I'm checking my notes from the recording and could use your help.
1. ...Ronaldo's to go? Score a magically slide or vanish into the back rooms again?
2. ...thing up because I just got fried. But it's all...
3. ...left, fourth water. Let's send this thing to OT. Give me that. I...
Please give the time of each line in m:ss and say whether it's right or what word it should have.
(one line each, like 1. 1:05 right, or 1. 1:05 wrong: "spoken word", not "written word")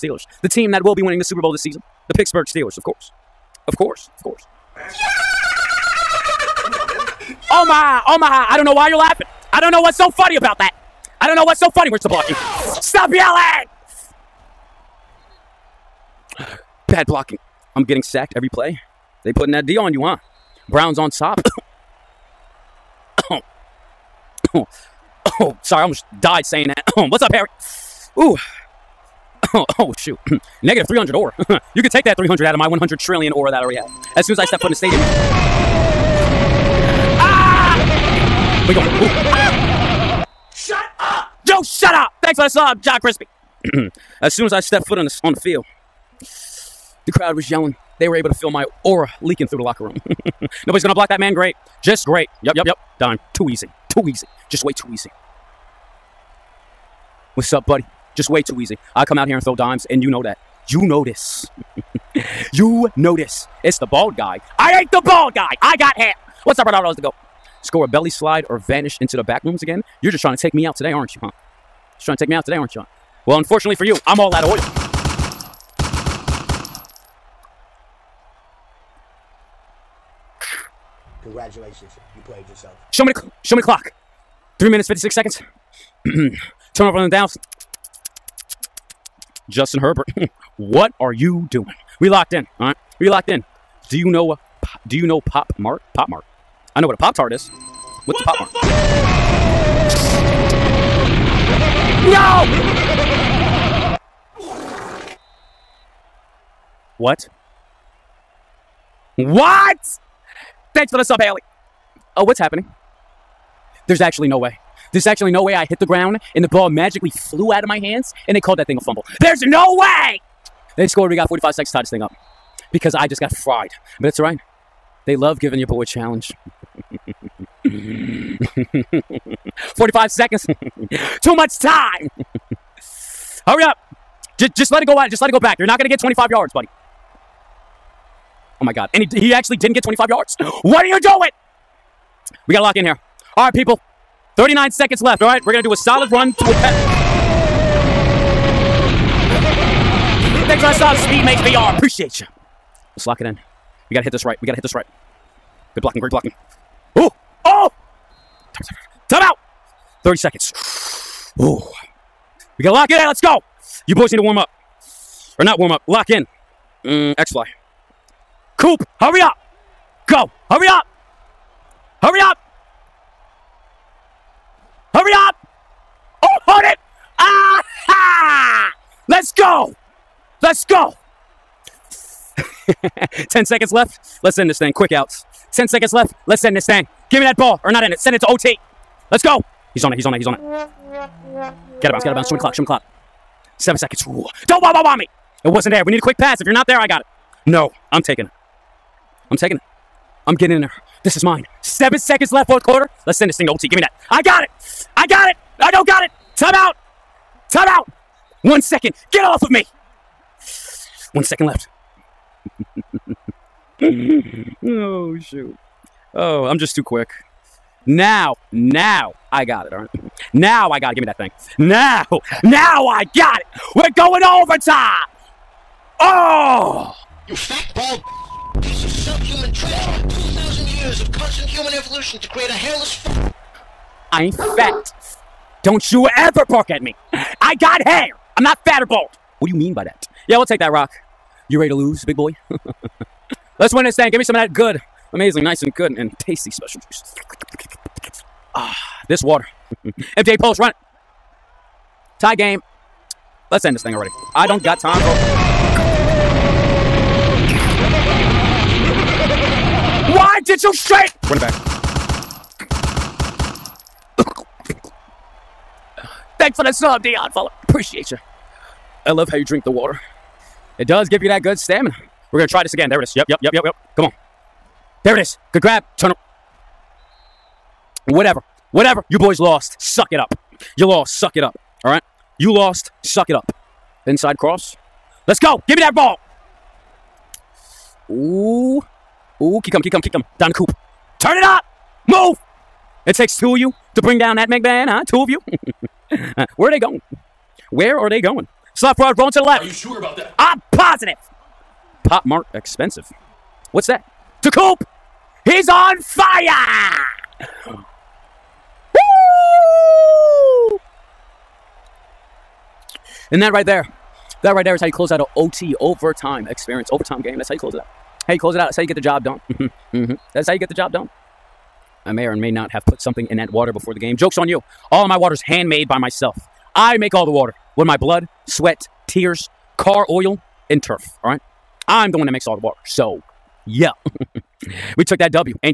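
1. 1:06 wrong: "belly", not "magically"
2. 2:01 right
3. 3:22 wrong: "quarter", not "water".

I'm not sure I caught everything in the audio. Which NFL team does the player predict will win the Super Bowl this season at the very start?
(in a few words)
Pittsburgh Steelers.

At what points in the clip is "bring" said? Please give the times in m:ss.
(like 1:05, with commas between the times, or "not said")
4:54.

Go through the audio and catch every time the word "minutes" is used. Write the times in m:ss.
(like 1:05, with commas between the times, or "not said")
1:24.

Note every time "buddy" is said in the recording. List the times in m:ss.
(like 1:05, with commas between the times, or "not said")
0:57, 2:16.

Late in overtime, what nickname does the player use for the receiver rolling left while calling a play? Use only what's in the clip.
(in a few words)
Slot fraud.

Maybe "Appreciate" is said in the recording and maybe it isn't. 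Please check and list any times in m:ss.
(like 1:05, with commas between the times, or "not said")
2:31, 4:27.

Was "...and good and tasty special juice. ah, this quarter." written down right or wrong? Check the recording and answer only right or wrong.
wrong.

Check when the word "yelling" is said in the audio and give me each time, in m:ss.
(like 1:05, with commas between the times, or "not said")
0:13, 0:47.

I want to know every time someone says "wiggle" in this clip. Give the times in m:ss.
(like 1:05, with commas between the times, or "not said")
0:38.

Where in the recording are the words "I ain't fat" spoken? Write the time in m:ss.
3:54.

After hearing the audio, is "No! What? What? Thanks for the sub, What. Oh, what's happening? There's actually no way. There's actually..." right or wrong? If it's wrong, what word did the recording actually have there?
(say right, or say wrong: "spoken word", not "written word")
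wrong: "Haley", not "What".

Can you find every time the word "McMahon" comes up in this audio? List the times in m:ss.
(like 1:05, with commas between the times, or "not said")
4:54.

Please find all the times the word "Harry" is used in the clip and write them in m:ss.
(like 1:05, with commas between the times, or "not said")
0:27.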